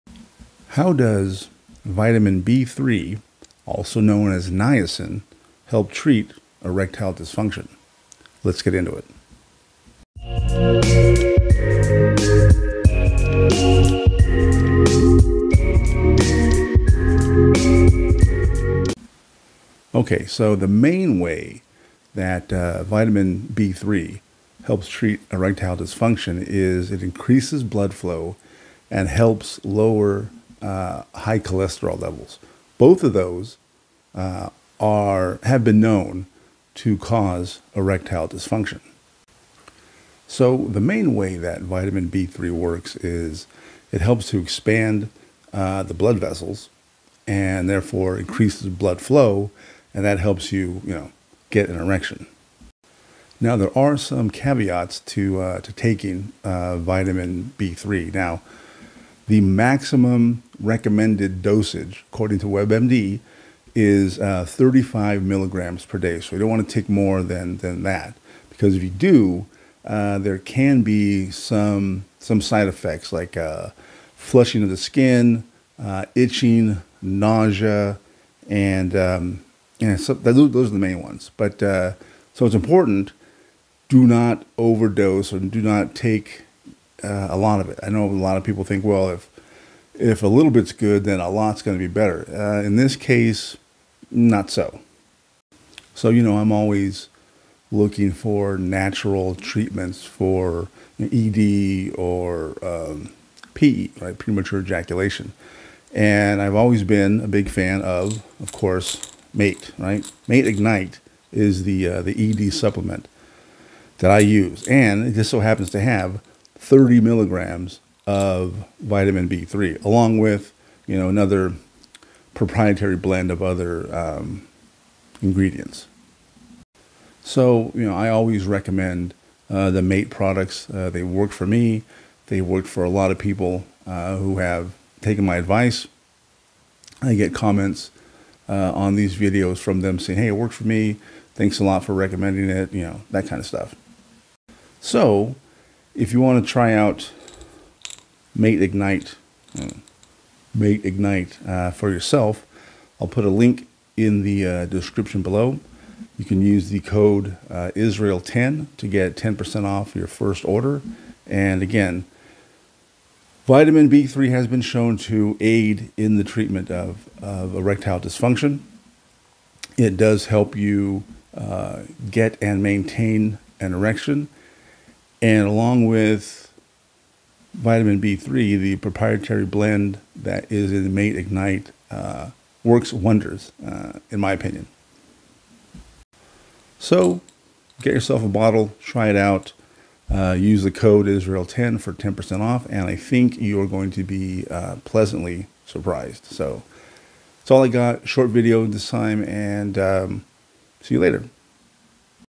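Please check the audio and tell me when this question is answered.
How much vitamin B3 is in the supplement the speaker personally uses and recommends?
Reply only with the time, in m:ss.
1:56.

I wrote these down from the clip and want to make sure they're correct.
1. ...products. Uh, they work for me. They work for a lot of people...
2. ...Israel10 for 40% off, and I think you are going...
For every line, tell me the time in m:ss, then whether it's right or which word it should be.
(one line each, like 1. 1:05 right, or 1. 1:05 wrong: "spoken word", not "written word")
1. 2:10 right
2. 3:11 wrong: "10", not "40".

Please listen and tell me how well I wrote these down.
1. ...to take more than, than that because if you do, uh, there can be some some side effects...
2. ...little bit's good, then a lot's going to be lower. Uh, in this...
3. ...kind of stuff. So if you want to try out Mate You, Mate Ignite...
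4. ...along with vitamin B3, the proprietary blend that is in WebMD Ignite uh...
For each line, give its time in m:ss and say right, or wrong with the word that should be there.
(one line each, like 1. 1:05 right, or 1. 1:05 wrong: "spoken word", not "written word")
1. 1:06 right
2. 1:30 wrong: "better", not "lower"
3. 2:23 wrong: "Ignite", not "You"
4. 2:55 wrong: "Mate", not "WebMD".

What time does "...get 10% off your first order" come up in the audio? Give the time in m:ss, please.
2:38.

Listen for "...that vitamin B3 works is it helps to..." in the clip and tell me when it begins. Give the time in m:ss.
0:41.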